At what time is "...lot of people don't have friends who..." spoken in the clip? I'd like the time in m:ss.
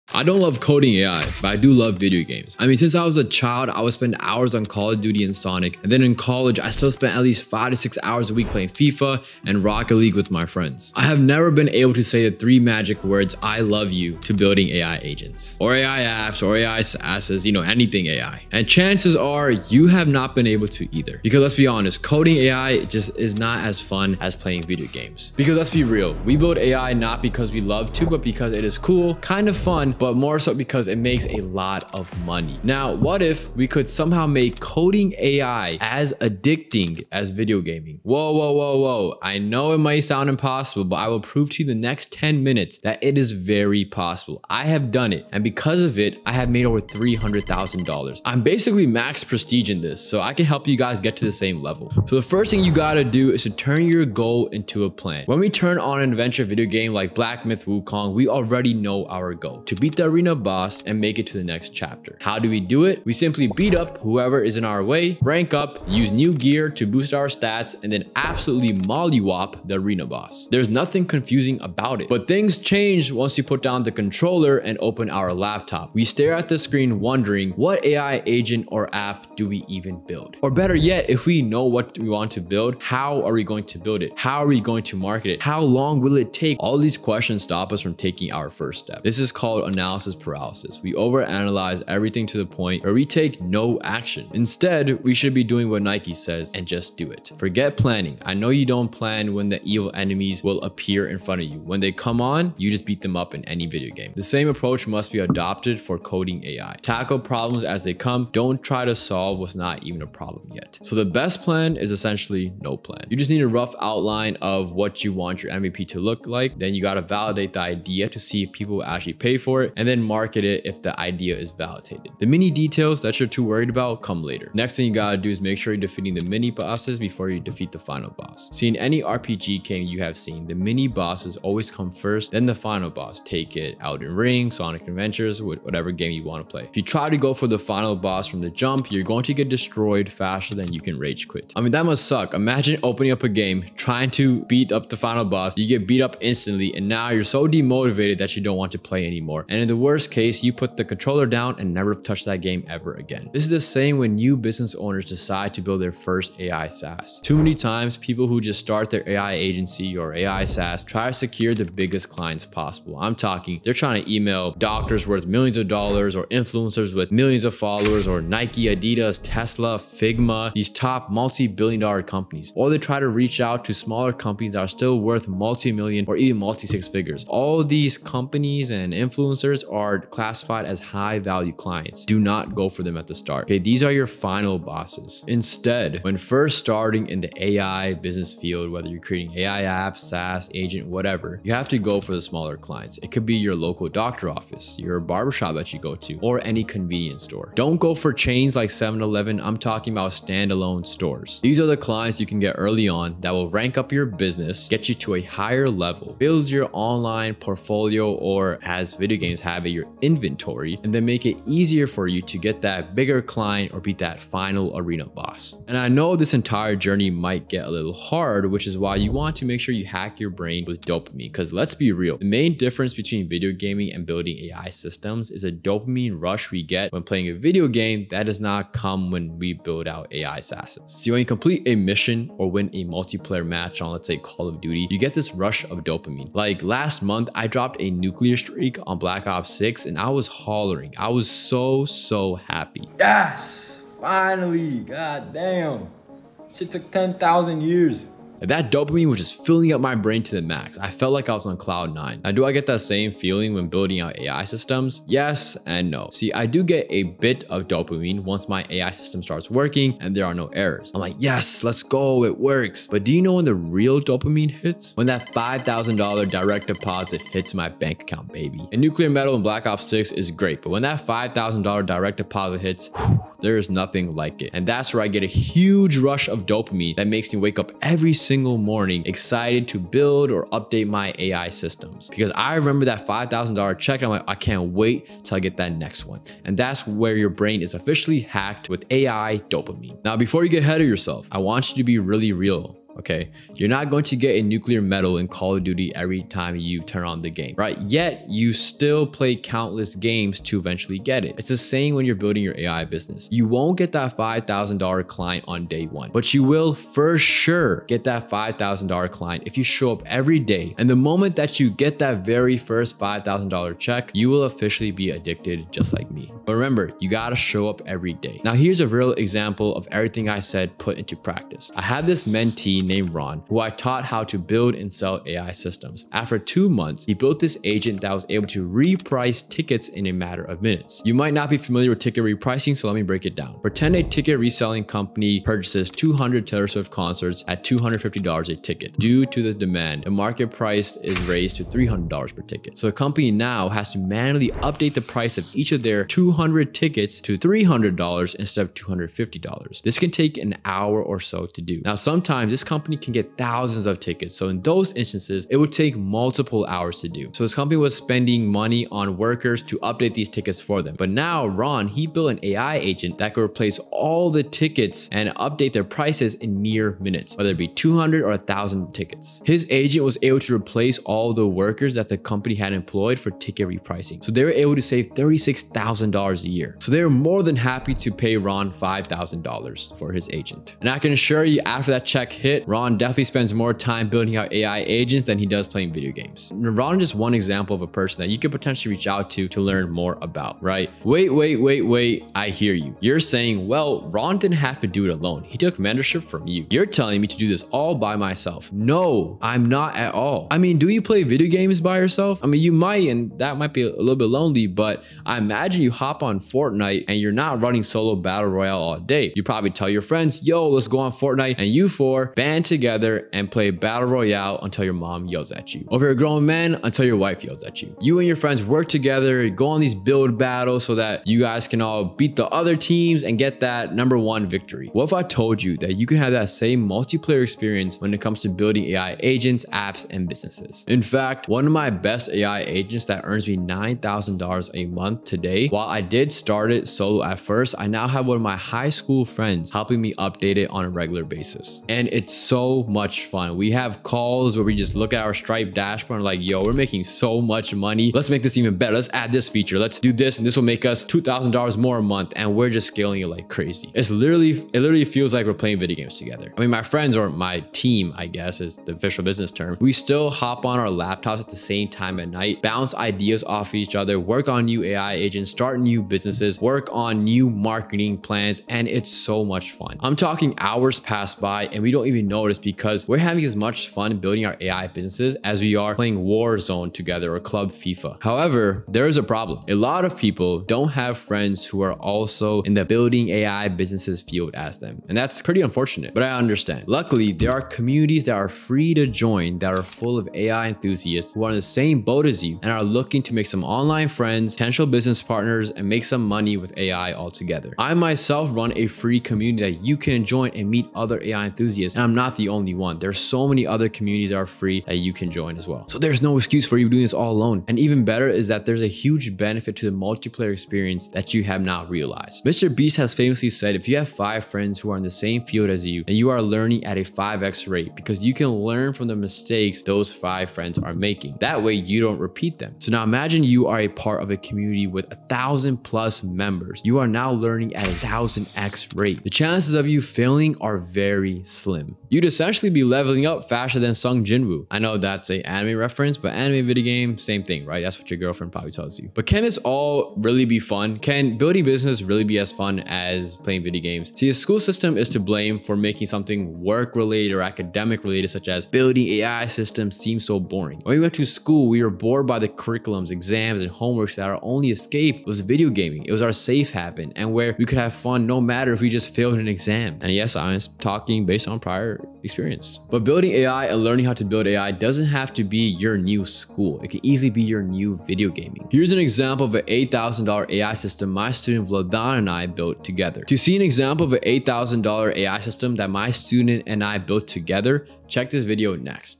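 7:59.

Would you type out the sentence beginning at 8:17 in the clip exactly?
I myself run a free community that you can join and meet other AI enthusiasts.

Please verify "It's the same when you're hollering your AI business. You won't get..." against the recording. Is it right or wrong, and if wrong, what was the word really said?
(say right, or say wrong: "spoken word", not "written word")
wrong: "building", not "hollering".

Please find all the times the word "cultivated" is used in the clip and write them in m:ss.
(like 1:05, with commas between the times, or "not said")
not said.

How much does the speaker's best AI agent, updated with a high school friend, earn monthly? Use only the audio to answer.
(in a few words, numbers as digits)
$9,000.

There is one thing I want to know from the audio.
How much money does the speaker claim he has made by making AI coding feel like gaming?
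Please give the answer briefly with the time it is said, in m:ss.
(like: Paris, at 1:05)
$300,000, at 0:46.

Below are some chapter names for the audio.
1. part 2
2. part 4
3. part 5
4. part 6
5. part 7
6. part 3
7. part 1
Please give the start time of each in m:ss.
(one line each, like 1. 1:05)
1. 2:04
2. 4:49
3. 6:32
4. 7:58
5. 8:59
6. 3:35
7. 0:52.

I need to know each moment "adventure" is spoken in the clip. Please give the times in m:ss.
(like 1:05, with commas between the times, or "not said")
0:56, 2:14.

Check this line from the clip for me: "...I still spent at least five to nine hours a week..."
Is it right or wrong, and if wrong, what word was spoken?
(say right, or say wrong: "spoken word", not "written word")
wrong: "six", not "nine".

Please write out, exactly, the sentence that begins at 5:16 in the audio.
But remember, you gotta show up every day.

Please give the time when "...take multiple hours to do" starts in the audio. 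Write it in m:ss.
5:55.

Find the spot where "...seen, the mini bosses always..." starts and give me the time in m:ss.
2:10.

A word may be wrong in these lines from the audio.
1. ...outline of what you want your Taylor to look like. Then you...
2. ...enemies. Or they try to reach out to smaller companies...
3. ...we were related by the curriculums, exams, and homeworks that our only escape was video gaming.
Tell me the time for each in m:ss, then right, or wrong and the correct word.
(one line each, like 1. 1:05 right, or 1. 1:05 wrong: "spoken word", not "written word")
1. 1:53 wrong: "MVP", not "Taylor"
2. 2:52 wrong: "companies", not "enemies"
3. 9:11 wrong: "bored", not "related".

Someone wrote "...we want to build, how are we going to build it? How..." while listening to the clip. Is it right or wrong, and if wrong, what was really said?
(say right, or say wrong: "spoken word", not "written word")
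right.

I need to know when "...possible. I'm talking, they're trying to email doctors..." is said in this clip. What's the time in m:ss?
2:42.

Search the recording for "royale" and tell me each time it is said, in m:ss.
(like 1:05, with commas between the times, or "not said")
6:48, 6:54.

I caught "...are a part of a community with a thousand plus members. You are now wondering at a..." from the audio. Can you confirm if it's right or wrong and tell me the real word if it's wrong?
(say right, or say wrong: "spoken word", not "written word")
wrong: "learning", not "wondering".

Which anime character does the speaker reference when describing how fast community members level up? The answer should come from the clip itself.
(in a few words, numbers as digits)
Sung Jinwoo.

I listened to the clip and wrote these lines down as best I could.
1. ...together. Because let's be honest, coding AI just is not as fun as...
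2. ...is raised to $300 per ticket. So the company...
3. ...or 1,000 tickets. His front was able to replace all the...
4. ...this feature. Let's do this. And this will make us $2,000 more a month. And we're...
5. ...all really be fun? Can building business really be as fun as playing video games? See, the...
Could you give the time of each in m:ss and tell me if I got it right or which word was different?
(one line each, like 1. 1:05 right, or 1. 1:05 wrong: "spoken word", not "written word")
1. 0:20 wrong: "either", not "together"
2. 5:40 right
3. 6:08 wrong: "agent", not "front"
4. 7:29 right
5. 8:59 right.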